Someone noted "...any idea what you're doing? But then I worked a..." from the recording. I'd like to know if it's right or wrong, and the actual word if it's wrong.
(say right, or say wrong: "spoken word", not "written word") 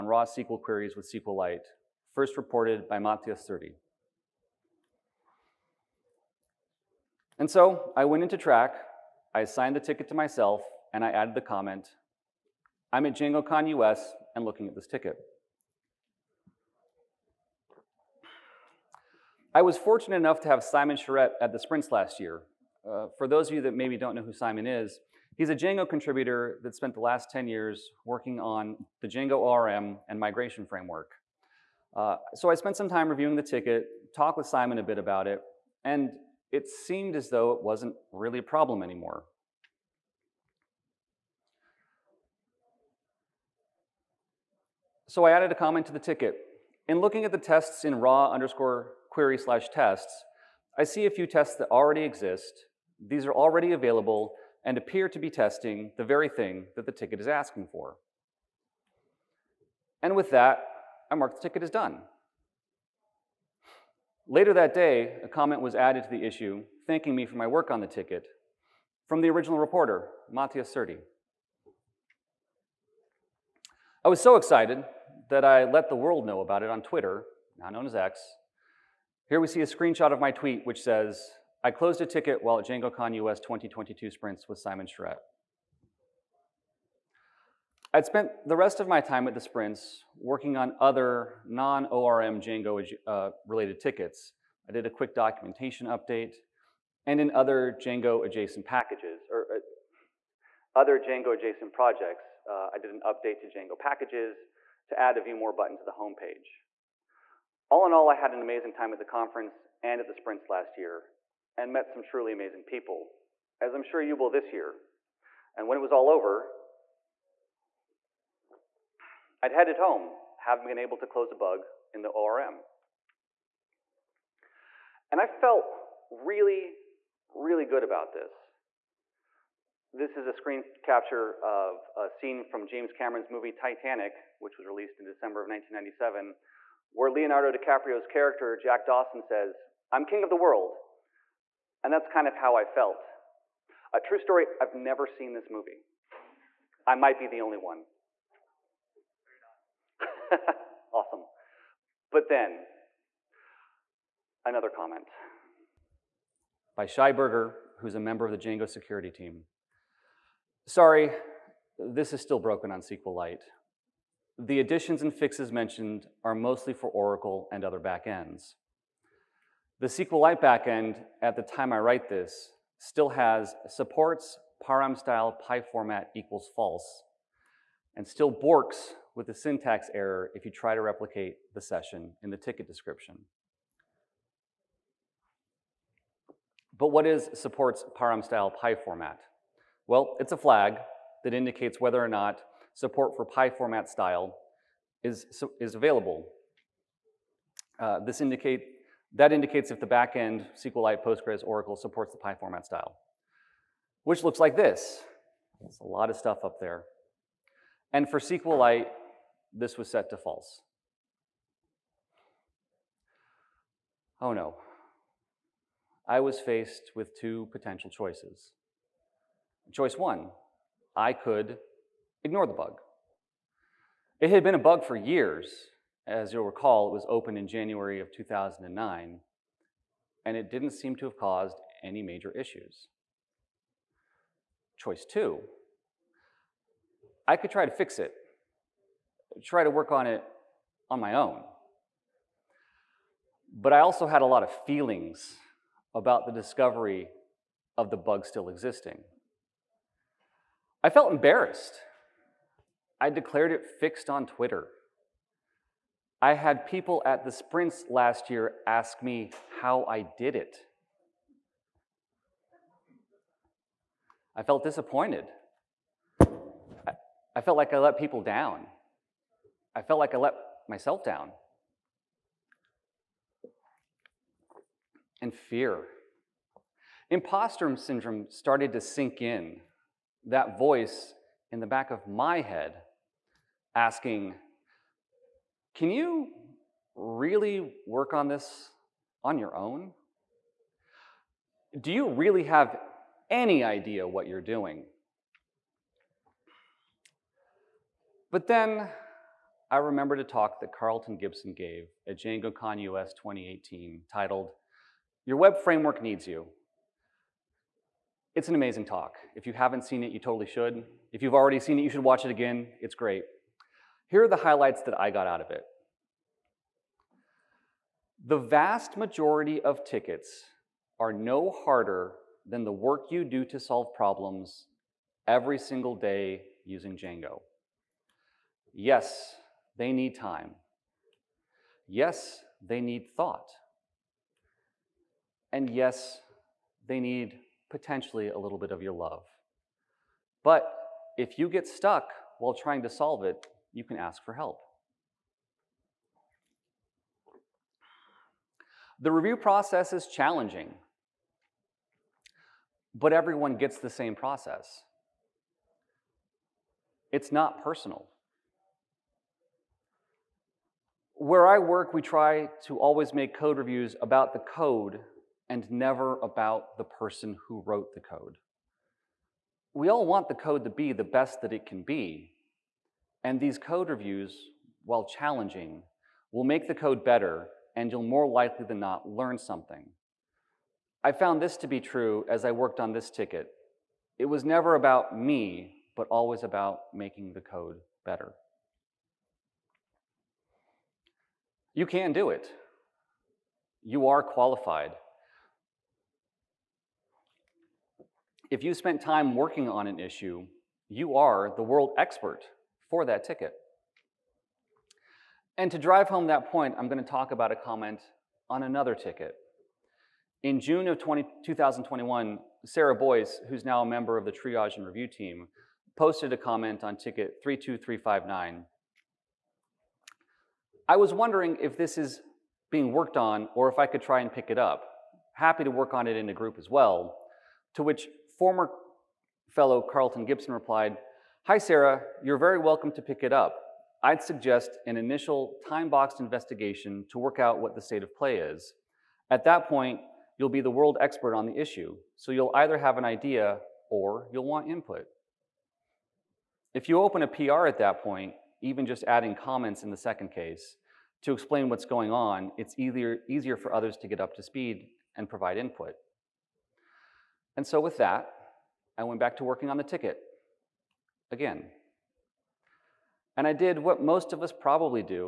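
wrong: "remembered", not "worked".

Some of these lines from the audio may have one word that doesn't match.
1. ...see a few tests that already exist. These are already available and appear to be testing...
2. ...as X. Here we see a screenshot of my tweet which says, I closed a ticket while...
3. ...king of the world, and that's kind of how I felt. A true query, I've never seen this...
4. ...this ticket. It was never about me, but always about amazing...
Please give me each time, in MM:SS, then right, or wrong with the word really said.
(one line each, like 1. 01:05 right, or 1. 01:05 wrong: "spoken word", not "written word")
1. 00:50 right
2. 01:17 right
3. 02:20 wrong: "story", not "query"
4. 06:22 wrong: "making", not "amazing".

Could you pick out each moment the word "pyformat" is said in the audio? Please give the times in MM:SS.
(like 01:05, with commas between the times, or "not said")
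02:55, 03:08, 03:13.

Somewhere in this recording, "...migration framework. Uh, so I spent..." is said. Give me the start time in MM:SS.
00:30.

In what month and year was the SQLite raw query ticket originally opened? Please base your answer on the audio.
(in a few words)
January 2009.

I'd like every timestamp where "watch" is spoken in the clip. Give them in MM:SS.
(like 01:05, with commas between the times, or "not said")
05:12.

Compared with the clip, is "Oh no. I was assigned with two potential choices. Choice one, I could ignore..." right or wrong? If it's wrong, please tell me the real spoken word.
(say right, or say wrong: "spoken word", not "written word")
wrong: "faced", not "assigned".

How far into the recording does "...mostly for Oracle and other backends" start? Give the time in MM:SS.
02:46.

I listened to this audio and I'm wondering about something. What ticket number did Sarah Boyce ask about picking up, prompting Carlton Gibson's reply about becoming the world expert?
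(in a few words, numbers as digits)
32359.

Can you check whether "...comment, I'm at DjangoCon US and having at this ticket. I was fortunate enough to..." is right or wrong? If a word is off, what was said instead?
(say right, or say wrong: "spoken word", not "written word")
wrong: "looking", not "having".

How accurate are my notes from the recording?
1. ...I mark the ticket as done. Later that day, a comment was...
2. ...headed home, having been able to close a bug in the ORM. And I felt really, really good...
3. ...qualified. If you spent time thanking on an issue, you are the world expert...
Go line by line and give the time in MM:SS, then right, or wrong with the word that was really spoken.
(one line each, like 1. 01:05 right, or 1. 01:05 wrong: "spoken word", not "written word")
1. 01:01 right
2. 01:59 right
3. 06:34 wrong: "working", not "thanking".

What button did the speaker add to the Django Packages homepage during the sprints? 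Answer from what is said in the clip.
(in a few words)
view more.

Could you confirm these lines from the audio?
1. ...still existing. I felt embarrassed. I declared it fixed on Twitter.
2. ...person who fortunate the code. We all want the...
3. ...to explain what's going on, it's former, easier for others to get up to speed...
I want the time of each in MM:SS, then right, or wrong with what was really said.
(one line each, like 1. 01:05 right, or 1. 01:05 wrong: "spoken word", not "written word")
1. 04:08 right
2. 06:06 wrong: "wrote", not "fortunate"
3. 07:31 wrong: "easier", not "former".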